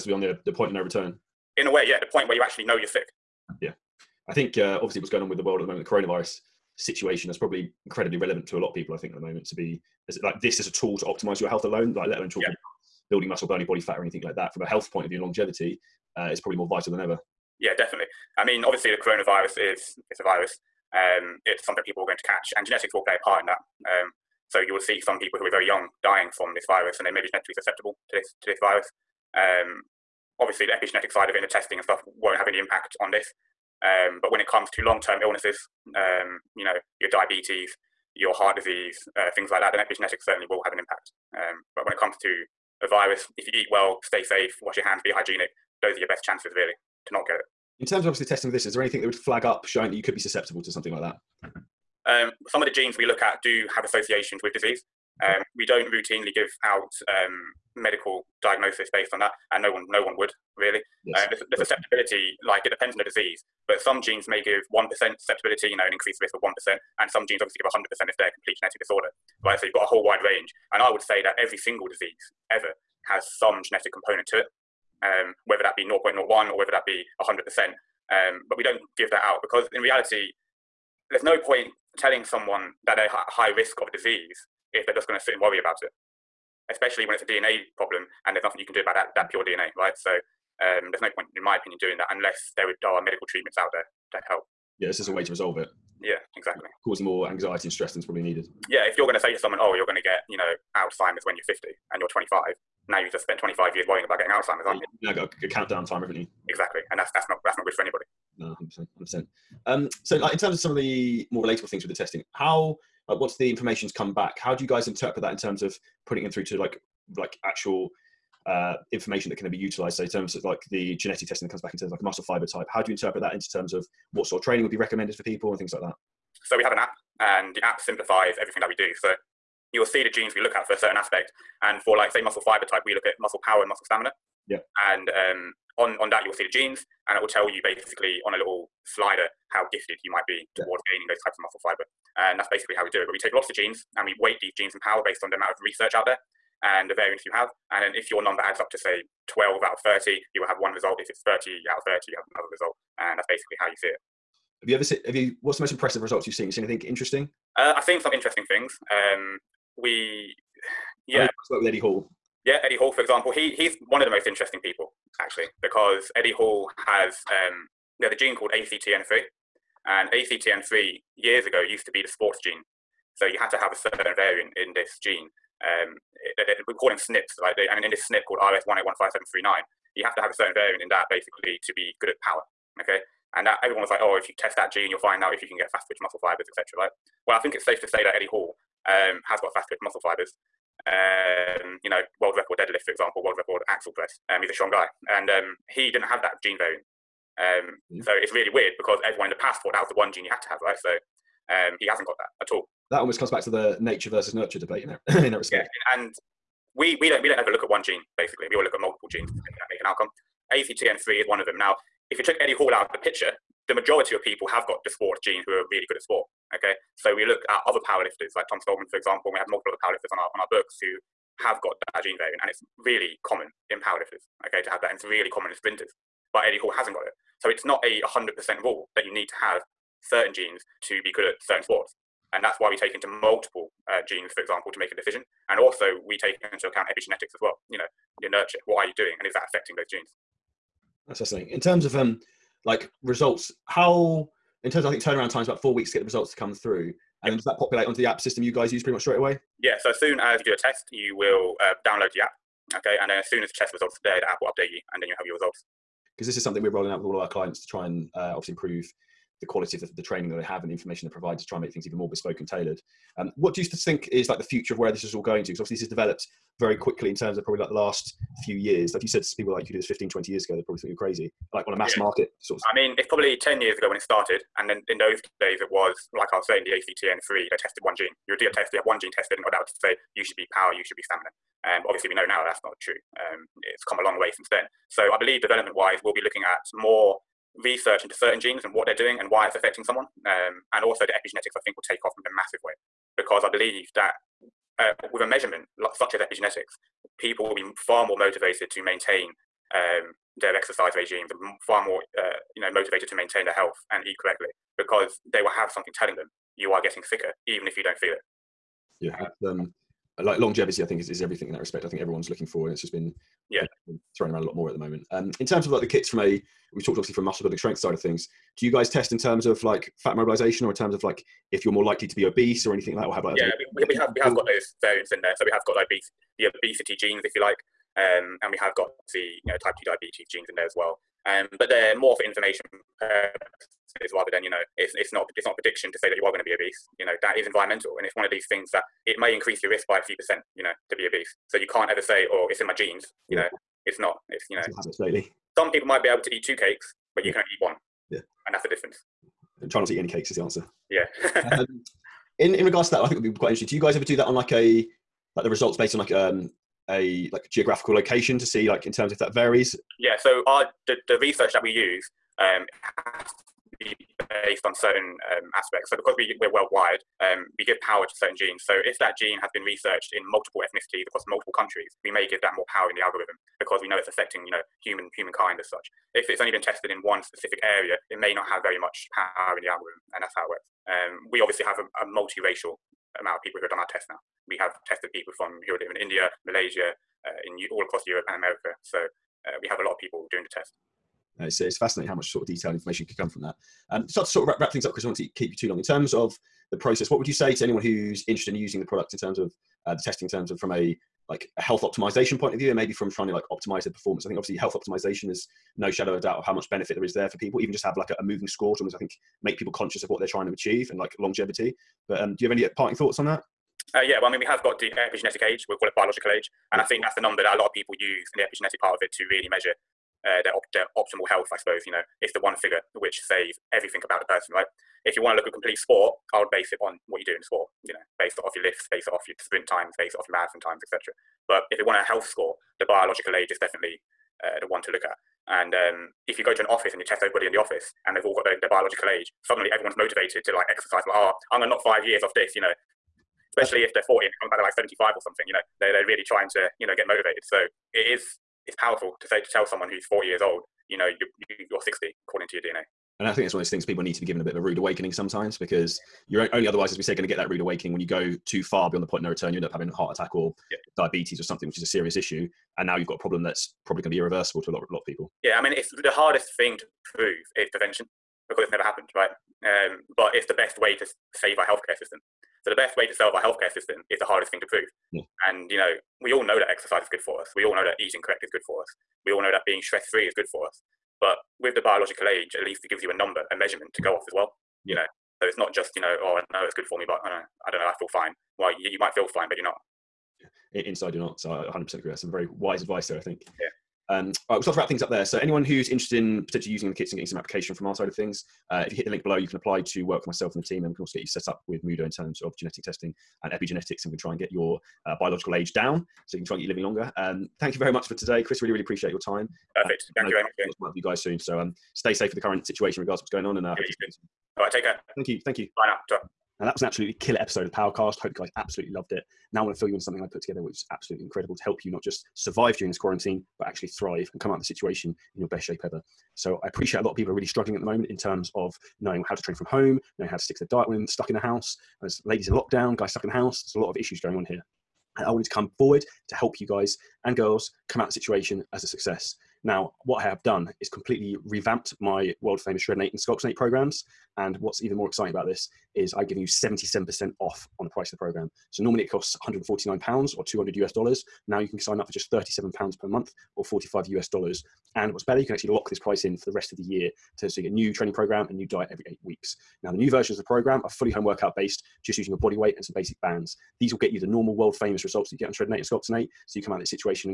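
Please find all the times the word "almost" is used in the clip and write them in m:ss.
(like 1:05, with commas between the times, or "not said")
3:22, 6:48.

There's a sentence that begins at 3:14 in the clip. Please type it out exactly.
Um, he's a strong guy, and um, he didn't have that gene variant.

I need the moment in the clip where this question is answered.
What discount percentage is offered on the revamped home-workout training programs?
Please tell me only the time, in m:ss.
9:06.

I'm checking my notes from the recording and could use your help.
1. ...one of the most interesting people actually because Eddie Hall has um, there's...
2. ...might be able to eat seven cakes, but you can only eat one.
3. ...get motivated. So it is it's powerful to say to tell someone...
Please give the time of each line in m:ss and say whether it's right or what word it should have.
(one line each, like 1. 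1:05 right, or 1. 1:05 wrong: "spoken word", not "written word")
1. 2:43 right
2. 5:45 wrong: "two", not "seven"
3. 7:26 right.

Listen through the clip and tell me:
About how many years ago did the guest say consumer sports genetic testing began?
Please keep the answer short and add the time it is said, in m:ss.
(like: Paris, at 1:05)
10 years, at 4:33.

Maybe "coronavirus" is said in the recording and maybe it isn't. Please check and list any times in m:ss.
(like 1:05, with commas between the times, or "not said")
0:05, 0:18.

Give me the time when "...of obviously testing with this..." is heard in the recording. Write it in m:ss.
0:48.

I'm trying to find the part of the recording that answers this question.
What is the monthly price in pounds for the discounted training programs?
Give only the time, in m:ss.
9:12.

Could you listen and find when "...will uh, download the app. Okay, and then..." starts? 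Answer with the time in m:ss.
4:11.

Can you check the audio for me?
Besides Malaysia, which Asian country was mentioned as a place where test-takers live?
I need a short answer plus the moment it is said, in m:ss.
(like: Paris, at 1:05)
India, at 6:25.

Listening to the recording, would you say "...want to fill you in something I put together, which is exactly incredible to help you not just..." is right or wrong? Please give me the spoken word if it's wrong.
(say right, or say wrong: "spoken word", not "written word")
wrong: "absolutely", not "exactly".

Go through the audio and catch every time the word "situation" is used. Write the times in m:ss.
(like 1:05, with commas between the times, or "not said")
0:06, 8:32, 8:44, 8:58.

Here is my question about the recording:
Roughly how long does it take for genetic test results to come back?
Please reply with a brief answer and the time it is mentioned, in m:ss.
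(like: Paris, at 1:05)
4 weeks, at 4:05.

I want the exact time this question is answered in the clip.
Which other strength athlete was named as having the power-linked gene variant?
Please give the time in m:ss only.
3:38.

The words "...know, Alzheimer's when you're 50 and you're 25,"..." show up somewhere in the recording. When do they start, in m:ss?
1:40.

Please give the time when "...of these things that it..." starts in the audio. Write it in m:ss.
5:38.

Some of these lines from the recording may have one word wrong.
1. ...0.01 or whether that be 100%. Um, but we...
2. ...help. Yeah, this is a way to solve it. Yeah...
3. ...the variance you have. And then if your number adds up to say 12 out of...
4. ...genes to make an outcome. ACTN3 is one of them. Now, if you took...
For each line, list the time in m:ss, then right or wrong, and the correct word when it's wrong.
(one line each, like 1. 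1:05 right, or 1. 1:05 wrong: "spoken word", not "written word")
1. 1:15 right
2. 1:34 wrong: "resolve", not "solve"
3. 2:26 right
4. 3:29 right.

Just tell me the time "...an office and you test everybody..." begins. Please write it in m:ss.
7:16.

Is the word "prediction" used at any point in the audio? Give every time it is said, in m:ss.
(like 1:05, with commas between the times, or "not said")
5:35.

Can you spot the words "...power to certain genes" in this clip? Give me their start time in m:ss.
6:07.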